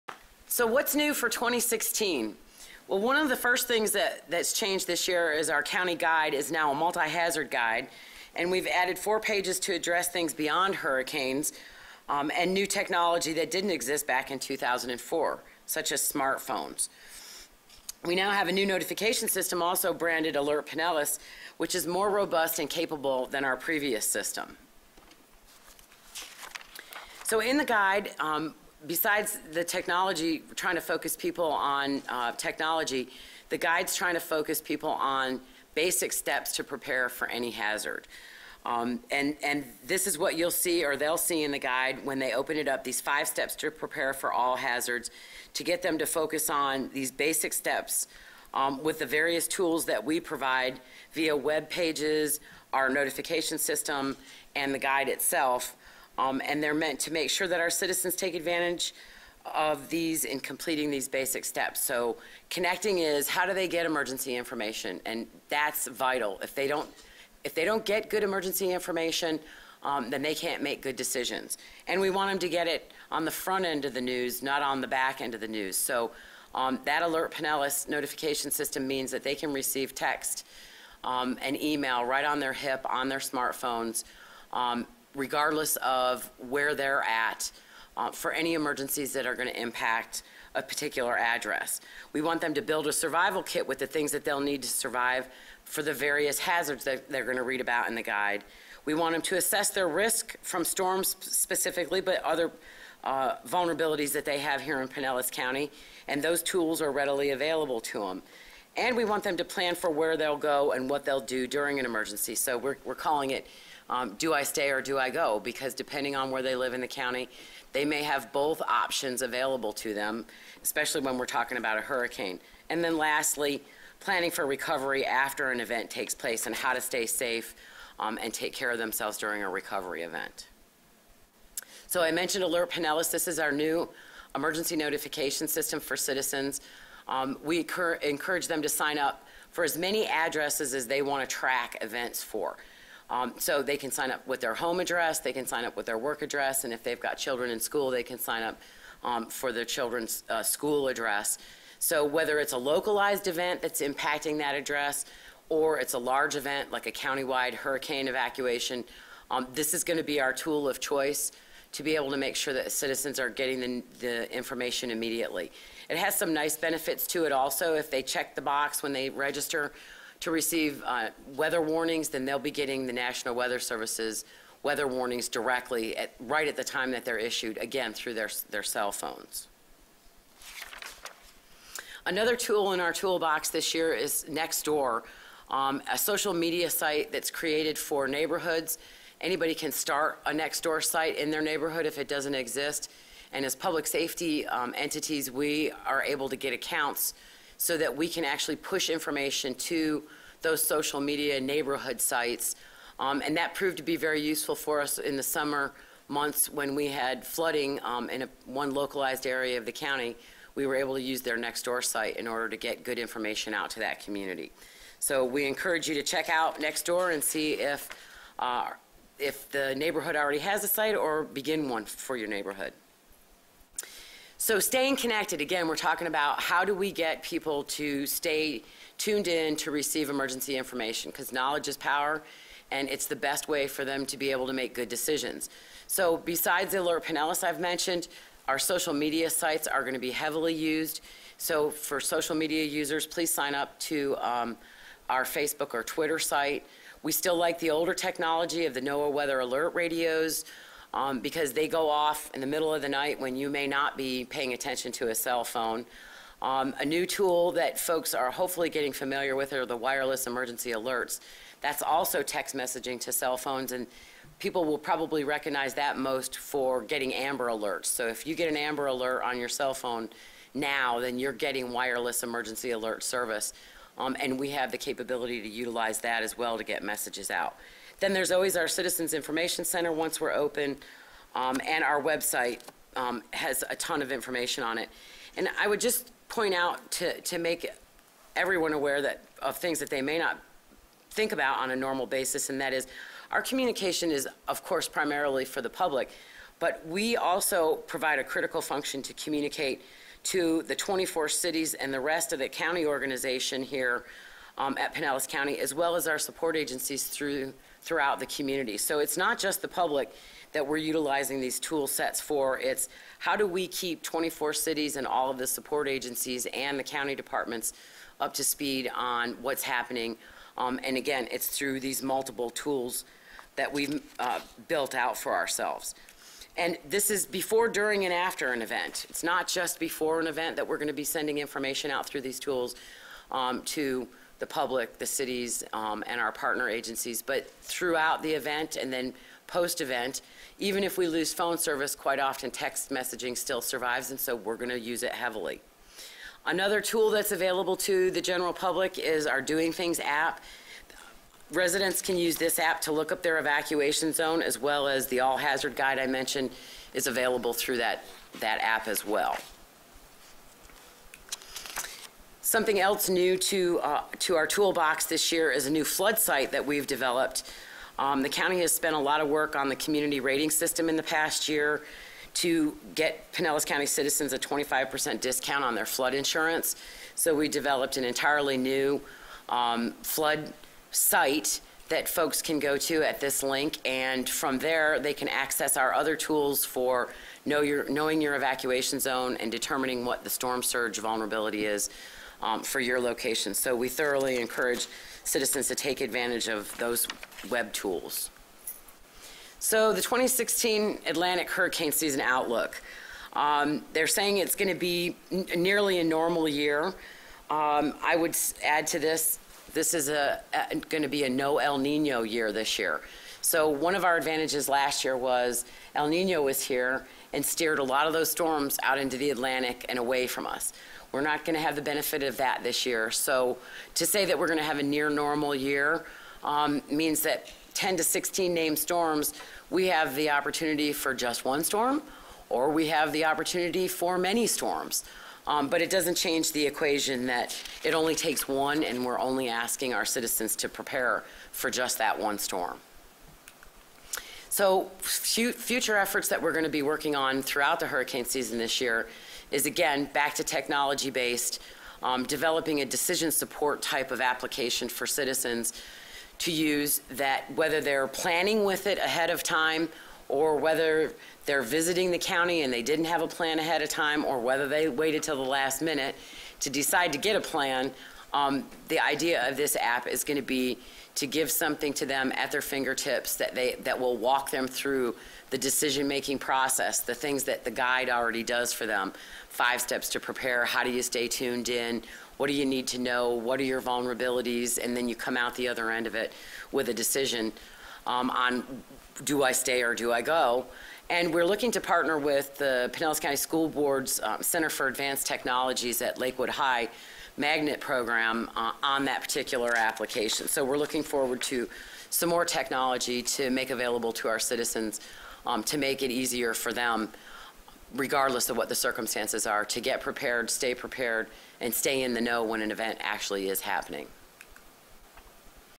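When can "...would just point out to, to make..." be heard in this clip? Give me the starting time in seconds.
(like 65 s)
285 s.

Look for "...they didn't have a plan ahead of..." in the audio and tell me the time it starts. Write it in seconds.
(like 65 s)
462 s.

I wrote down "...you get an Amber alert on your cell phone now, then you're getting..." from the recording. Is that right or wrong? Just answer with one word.
right.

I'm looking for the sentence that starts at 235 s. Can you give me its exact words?
So besides the Alert Pinellas I've mentioned, our social media sites are going to be heavily used.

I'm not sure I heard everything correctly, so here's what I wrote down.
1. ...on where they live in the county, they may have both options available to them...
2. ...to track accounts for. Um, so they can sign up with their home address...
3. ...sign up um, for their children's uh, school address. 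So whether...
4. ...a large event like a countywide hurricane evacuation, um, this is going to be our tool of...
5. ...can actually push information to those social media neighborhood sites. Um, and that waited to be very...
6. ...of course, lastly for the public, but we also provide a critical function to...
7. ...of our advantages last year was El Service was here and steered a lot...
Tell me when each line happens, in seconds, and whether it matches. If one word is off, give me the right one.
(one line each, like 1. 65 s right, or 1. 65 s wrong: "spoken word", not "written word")
1. 116 s right
2. 141 s wrong: "events", not "accounts"
3. 148 s right
4. 155 s right
5. 198 s wrong: "proved", not "waited"
6. 294 s wrong: "primarily", not "lastly"
7. 413 s wrong: "Nino", not "Service".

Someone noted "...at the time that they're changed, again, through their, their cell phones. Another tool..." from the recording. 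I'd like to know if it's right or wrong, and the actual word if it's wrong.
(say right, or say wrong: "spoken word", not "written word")
wrong: "issued", not "changed".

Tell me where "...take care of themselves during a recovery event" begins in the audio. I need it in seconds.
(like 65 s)
128 s.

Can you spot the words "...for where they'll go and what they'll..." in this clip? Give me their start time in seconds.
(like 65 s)
109 s.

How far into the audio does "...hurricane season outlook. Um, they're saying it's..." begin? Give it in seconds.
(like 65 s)
401 s.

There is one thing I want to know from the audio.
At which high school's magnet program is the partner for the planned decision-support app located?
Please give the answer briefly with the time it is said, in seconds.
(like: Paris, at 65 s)
Lakewood High, at 496 s.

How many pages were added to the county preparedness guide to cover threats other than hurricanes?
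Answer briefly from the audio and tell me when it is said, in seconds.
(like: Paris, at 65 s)
4, at 8 s.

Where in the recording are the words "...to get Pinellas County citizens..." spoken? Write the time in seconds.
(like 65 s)
372 s.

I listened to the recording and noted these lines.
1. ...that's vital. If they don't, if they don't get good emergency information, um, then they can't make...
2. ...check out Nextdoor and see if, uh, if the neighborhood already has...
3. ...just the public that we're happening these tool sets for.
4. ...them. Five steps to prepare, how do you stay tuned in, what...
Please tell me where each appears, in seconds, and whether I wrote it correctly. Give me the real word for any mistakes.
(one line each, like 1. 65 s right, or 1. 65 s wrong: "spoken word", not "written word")
1. 65 s right
2. 216 s right
3. 309 s wrong: "utilizing", not "happening"
4. 478 s right.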